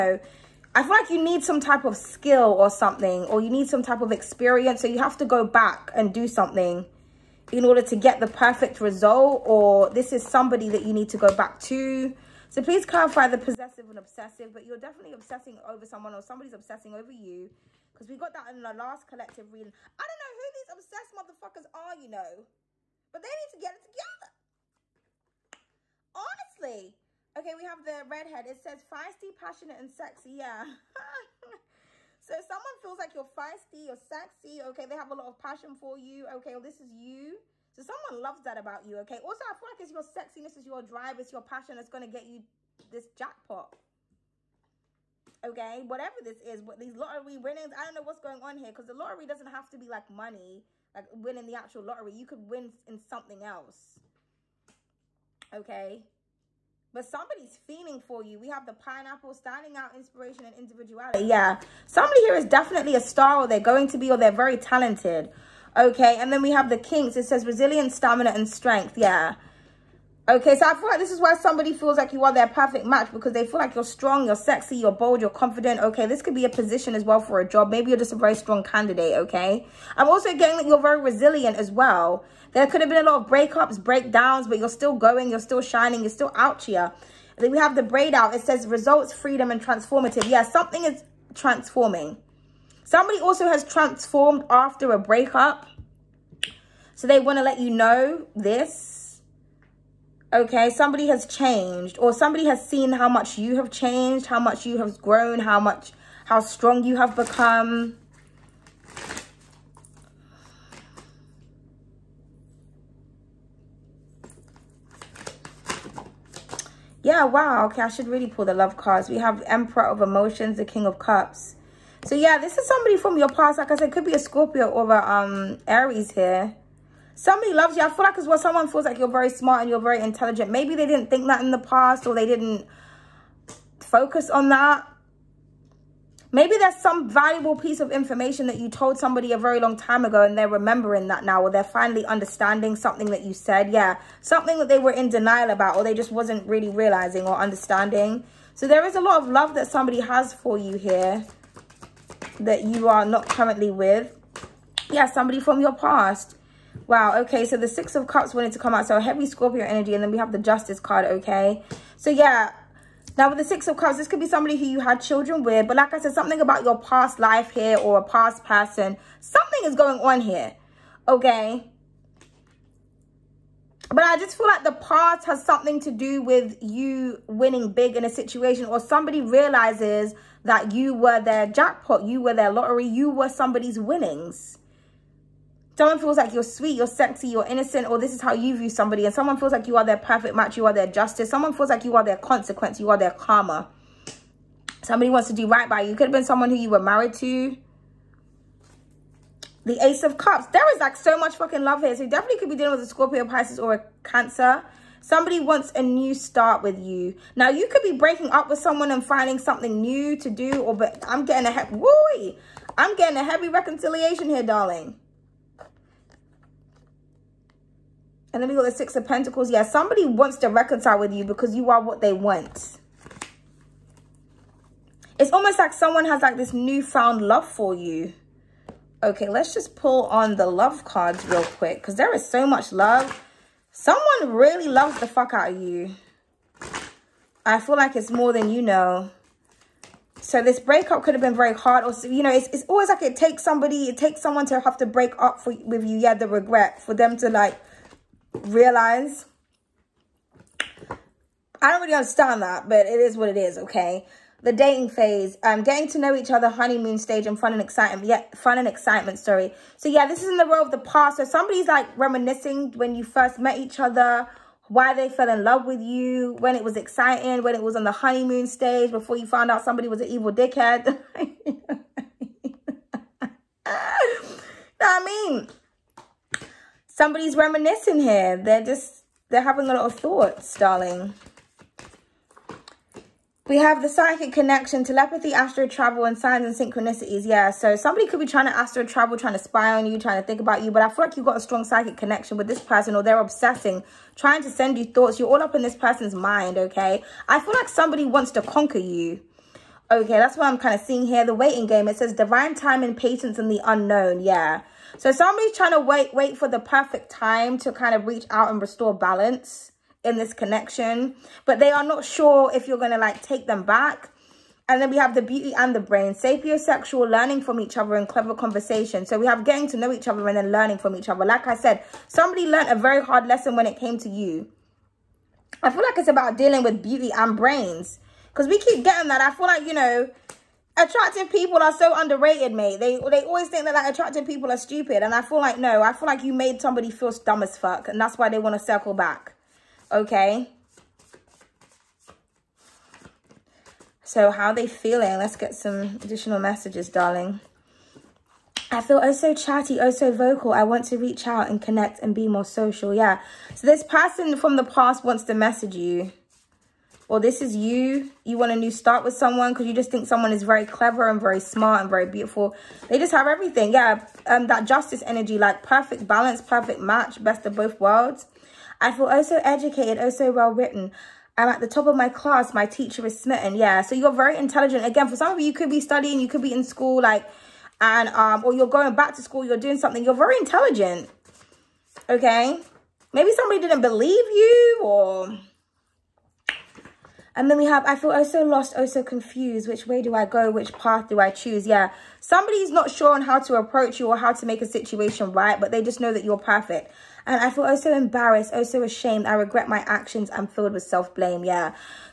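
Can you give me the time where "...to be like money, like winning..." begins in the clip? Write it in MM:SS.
00:49.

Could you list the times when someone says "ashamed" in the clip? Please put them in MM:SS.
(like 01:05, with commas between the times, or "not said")
06:38.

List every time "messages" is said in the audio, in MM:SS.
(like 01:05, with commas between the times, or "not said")
05:46, 05:55.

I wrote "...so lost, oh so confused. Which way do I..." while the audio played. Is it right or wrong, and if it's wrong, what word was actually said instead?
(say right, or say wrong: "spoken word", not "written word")
right.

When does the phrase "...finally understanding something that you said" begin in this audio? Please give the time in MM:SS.
02:21.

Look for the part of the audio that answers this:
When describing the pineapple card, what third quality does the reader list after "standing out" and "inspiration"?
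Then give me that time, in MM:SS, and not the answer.
01:00.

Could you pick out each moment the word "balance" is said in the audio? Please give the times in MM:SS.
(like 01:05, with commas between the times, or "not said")
05:08, 06:06.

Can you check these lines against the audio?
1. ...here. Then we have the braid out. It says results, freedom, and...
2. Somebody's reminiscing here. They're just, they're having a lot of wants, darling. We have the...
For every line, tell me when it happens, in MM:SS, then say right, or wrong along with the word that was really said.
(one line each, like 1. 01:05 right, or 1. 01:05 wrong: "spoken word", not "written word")
1. 01:26 right
2. 04:36 wrong: "thoughts", not "wants".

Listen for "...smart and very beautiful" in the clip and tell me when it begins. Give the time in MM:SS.
06:01.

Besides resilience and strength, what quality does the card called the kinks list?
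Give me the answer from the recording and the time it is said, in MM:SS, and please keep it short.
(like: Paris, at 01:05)
stamina, at 01:07.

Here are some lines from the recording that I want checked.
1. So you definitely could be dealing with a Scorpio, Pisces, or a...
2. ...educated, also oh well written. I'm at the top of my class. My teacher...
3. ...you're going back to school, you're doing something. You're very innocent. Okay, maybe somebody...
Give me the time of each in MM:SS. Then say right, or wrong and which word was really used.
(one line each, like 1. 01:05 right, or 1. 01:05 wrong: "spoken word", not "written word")
1. 03:21 right
2. 06:09 right
3. 06:18 wrong: "intelligent", not "innocent".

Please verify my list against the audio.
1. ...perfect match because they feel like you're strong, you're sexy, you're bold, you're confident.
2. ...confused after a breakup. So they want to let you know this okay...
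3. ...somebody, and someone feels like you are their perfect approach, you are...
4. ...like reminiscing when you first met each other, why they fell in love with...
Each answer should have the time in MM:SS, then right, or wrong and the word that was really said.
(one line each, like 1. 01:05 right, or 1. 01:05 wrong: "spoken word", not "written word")
1. 01:12 right
2. 01:33 wrong: "transformed", not "confused"
3. 03:08 wrong: "match", not "approach"
4. 04:21 right.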